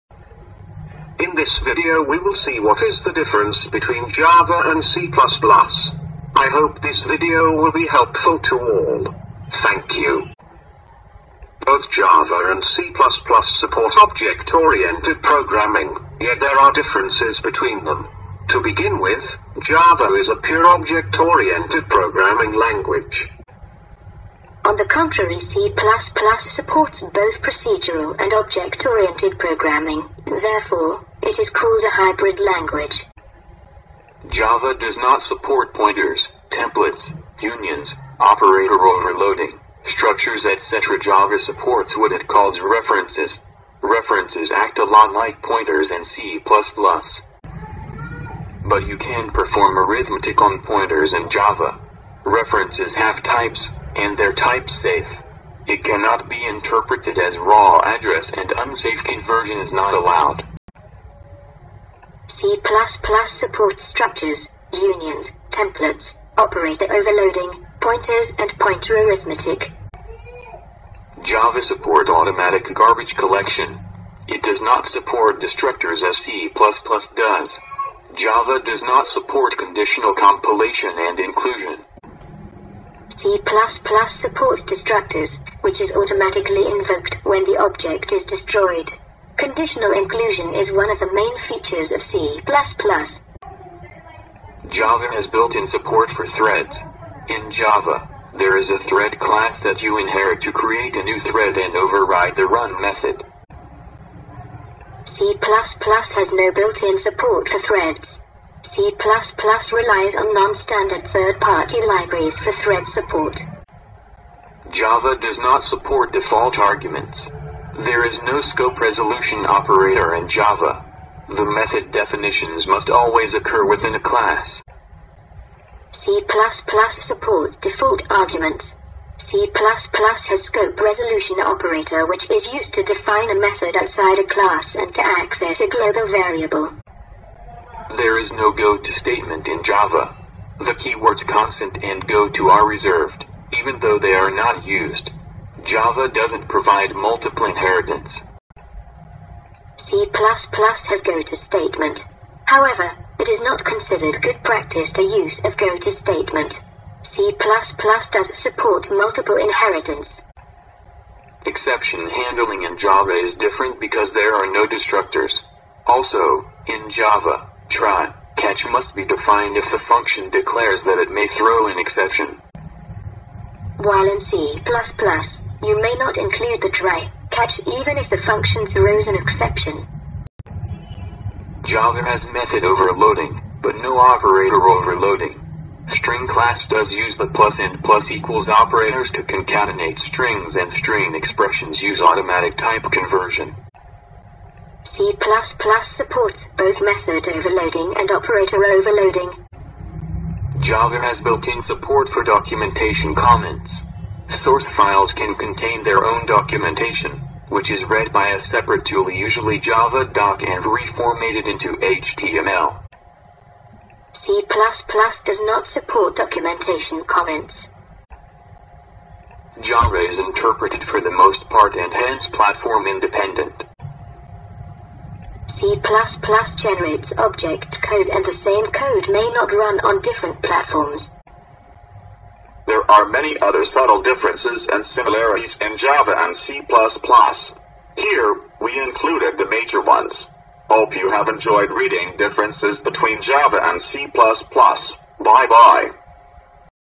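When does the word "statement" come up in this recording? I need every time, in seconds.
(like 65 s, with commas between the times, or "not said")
138 s, 151 s, 155 s.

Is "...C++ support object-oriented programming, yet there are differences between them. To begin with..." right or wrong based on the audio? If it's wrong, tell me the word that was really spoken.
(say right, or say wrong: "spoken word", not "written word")
right.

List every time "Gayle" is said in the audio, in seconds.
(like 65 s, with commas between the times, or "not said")
not said.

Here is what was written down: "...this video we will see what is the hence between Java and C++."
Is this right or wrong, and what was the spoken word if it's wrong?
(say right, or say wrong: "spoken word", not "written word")
wrong: "difference", not "hence".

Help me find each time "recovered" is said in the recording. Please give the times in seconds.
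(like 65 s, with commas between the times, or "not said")
not said.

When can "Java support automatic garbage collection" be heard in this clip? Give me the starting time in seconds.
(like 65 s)
71 s.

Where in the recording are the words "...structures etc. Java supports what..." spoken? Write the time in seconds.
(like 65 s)
39 s.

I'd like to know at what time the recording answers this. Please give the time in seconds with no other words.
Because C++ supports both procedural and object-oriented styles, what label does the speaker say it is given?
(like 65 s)
31 s.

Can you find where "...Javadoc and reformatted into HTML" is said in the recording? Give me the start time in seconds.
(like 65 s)
209 s.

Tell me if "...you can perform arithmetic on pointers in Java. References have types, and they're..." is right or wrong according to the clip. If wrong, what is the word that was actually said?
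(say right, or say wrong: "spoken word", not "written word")
right.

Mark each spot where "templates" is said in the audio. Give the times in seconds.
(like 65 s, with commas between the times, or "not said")
36 s, 65 s.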